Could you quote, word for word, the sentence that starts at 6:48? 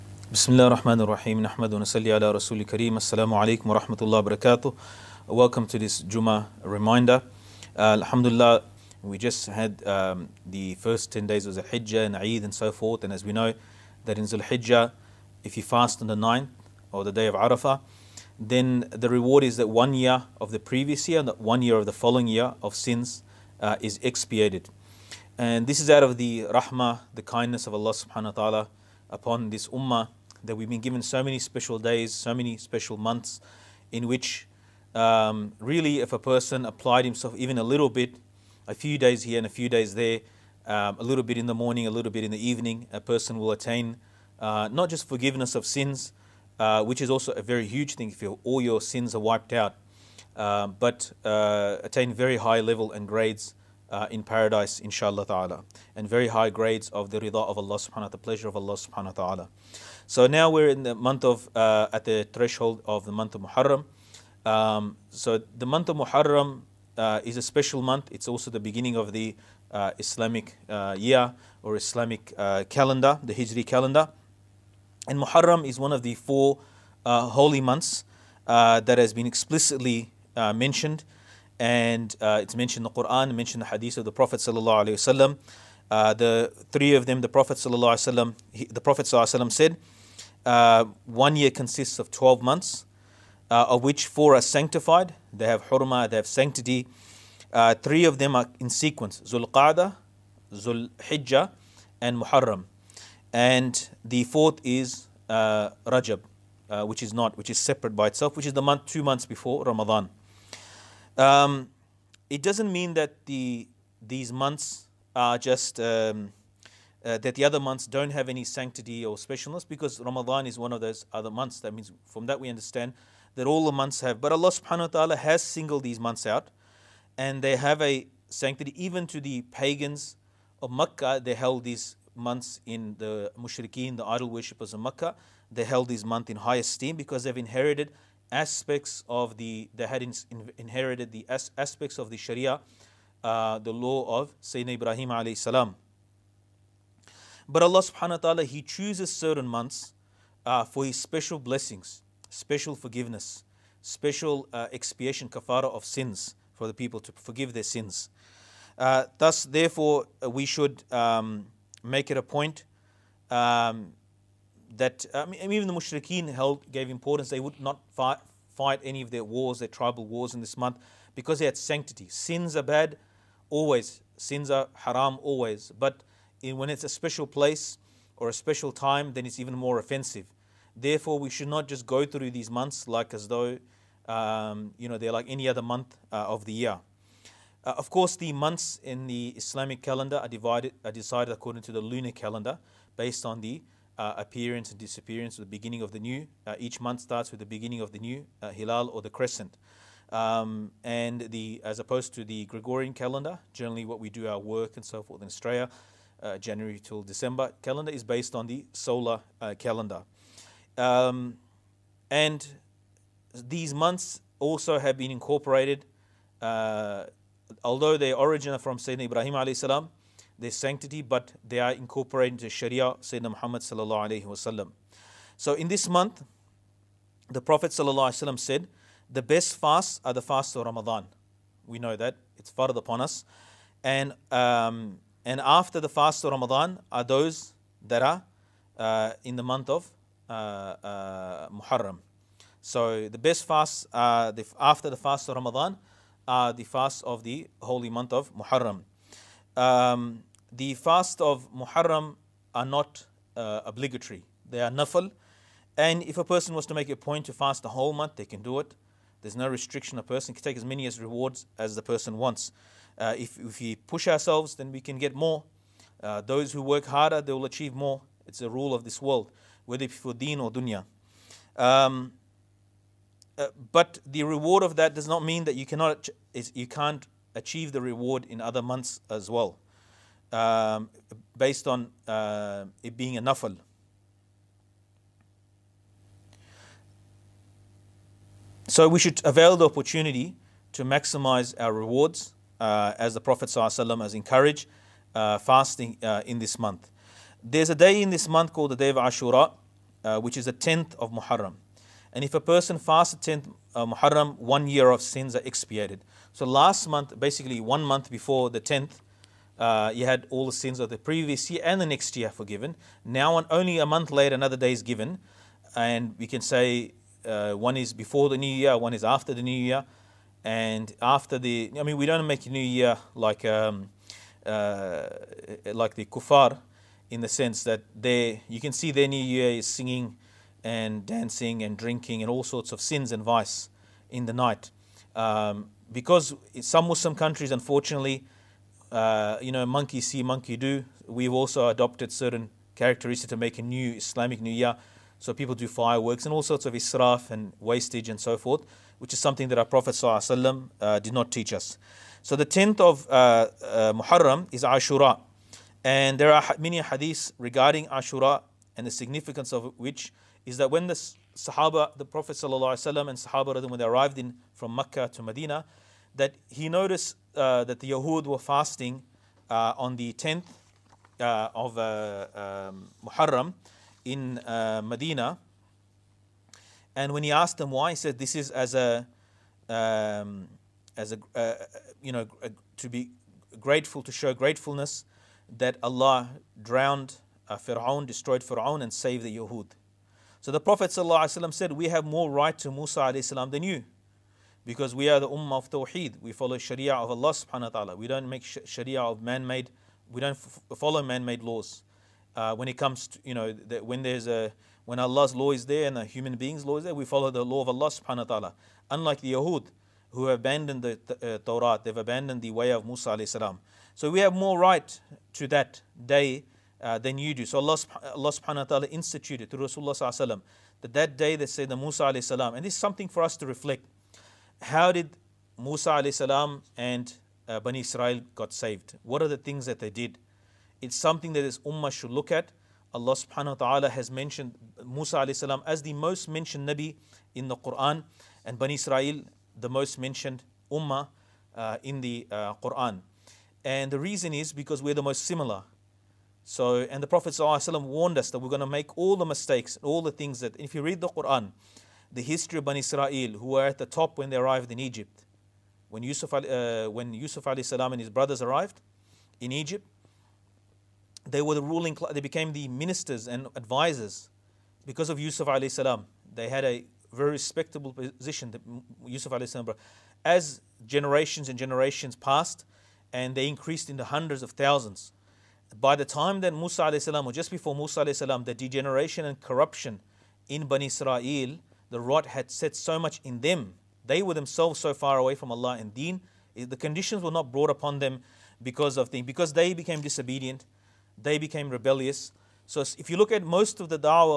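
Unlike the Yahud, who have abandoned the uh, Torah, they've abandoned the way of Musa alayhi salam.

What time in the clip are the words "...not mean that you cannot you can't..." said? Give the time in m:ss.
4:35.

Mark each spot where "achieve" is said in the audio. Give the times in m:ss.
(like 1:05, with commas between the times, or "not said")
4:27, 4:37.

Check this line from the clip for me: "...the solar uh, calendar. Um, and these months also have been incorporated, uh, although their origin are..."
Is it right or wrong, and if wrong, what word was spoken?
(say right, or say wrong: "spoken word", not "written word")
right.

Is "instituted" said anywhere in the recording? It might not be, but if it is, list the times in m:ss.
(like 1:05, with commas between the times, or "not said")
6:58.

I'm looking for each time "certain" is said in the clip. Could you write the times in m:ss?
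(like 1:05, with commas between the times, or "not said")
2:29, 5:42.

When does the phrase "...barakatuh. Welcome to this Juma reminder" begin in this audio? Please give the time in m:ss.
0:04.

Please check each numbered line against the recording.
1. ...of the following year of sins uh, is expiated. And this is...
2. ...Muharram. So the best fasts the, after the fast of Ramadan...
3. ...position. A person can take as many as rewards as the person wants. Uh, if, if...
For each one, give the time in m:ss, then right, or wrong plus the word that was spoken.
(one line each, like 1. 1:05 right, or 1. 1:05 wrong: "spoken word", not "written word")
1. 0:21 right
2. 4:01 right
3. 4:19 wrong: "restriction", not "position".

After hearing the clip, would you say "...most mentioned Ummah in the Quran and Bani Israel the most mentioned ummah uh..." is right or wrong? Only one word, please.
wrong.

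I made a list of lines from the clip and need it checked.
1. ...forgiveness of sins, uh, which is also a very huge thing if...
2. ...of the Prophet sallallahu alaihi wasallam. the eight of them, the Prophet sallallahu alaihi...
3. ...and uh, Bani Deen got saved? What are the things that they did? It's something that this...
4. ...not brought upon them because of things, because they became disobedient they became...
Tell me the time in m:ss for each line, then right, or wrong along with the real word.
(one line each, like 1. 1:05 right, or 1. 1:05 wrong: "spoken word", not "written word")
1. 0:45 right
2. 1:23 wrong: "three", not "eight"
3. 7:06 wrong: "Israel", not "Deen"
4. 8:07 right.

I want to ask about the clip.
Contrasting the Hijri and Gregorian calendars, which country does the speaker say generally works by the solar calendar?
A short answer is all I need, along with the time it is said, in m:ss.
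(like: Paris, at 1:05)
Australia, at 3:25.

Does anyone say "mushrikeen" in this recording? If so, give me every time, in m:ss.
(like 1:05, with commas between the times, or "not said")
2:13, 2:45.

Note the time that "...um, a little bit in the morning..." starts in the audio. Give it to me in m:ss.
0:40.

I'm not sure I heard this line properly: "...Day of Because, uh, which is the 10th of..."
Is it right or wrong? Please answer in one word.
wrong.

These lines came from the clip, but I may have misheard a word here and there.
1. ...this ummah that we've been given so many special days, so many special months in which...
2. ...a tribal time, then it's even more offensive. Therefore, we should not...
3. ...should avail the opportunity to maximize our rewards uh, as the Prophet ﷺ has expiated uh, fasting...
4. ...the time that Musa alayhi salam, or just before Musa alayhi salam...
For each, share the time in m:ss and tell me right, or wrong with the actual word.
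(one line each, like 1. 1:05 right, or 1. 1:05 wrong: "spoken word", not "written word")
1. 0:29 right
2. 2:58 wrong: "special", not "tribal"
3. 4:48 wrong: "encouraged", not "expiated"
4. 7:55 right.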